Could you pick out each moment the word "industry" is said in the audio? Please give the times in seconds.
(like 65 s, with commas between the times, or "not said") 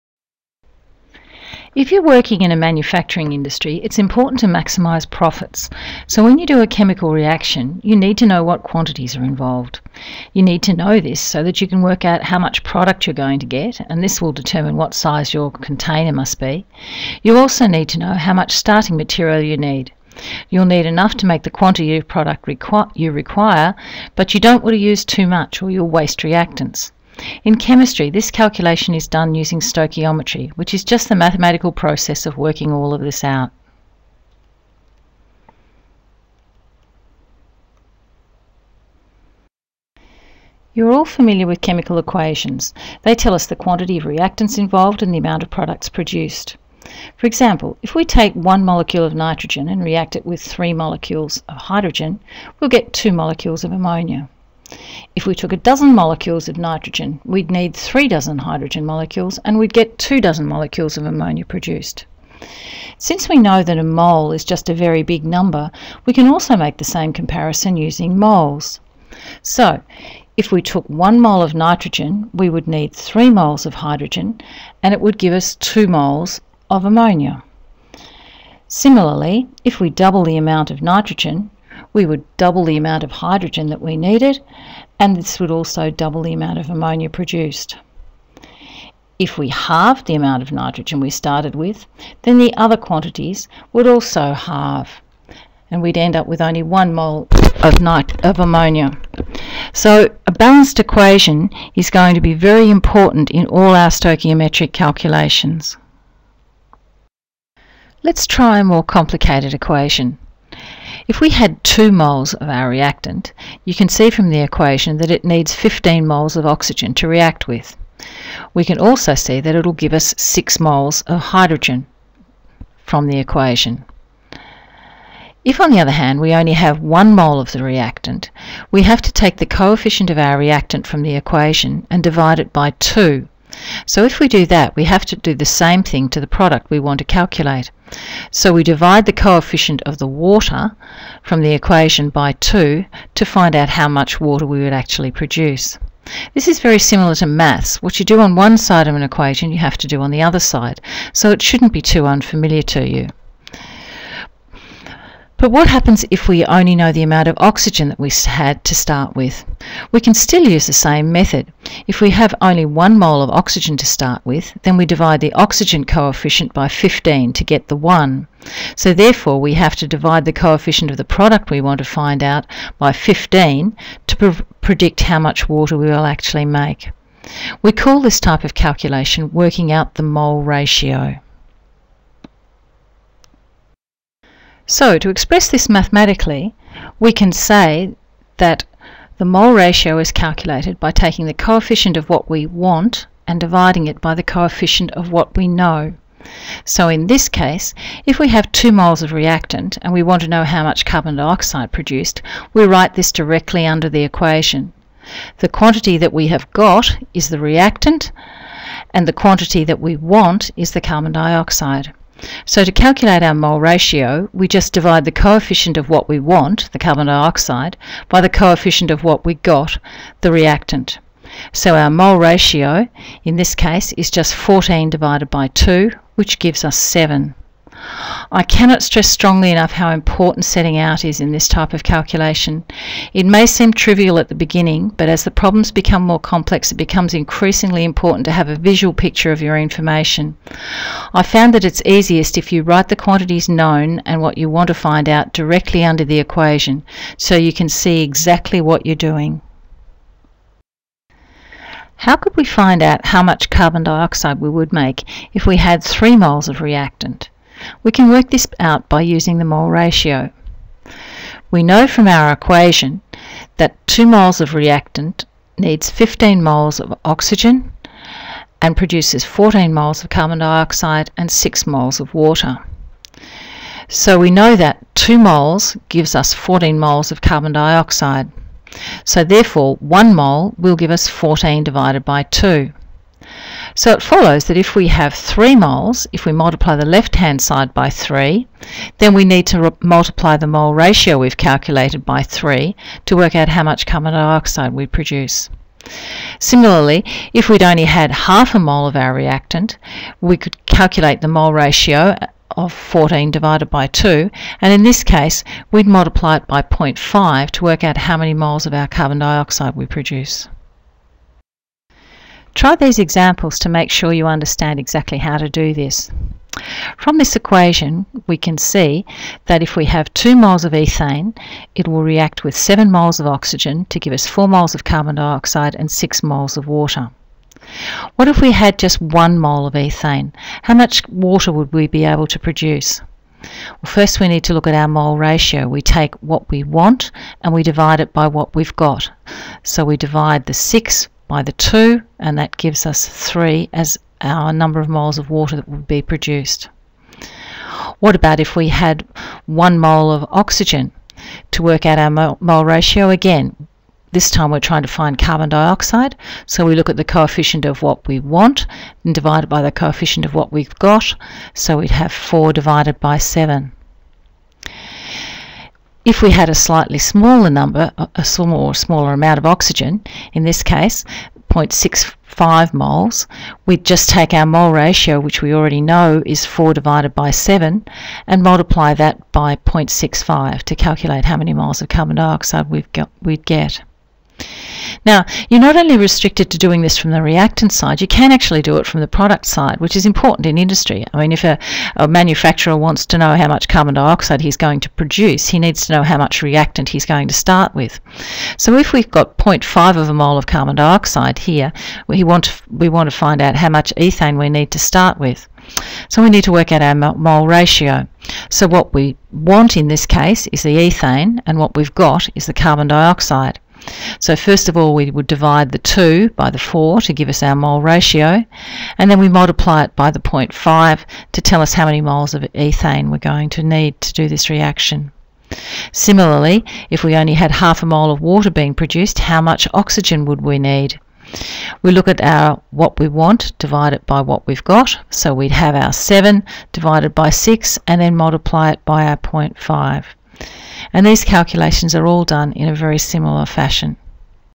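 3 s, 390 s.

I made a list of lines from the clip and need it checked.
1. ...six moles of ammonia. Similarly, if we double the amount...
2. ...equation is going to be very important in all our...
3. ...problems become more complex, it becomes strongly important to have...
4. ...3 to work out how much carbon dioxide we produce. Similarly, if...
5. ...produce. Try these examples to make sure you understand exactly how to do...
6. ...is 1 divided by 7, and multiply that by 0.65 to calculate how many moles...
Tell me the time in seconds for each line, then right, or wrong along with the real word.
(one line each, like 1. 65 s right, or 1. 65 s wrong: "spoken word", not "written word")
1. 75 s wrong: "two", not "six"
2. 100 s right
3. 235 s wrong: "increasingly", not "strongly"
4. 292 s right
5. 309 s right
6. 376 s wrong: "4", not "1".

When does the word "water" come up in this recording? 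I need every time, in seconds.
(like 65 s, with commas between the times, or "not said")
140 s, 144 s, 175 s, 272 s, 326 s, 331 s, 345 s, 428 s.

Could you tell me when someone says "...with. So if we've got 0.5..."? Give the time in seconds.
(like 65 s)
397 s.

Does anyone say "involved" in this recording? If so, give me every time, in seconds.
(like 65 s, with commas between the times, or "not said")
9 s, 44 s.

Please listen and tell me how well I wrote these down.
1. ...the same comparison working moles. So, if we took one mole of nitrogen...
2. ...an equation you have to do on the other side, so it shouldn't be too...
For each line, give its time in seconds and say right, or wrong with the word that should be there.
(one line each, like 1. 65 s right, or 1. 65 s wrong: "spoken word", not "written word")
1. 66 s wrong: "using", not "working"
2. 148 s right.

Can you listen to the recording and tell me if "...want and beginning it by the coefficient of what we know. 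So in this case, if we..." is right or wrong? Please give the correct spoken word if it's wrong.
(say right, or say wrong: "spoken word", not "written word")
wrong: "dividing", not "beginning".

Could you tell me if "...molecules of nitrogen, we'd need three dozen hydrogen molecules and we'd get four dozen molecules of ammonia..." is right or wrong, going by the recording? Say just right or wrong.
wrong.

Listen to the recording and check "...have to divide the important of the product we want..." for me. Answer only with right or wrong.
wrong.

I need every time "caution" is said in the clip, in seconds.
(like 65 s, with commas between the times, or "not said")
not said.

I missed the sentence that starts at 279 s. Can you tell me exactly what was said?
So therefore 1 mole will give us 14 divided by 2.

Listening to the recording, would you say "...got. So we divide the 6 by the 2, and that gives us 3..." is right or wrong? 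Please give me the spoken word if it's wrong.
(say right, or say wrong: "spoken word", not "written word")
right.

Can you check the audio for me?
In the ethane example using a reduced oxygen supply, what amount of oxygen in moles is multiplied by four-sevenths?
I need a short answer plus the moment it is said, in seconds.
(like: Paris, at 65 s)
0.65 moles, at 371 s.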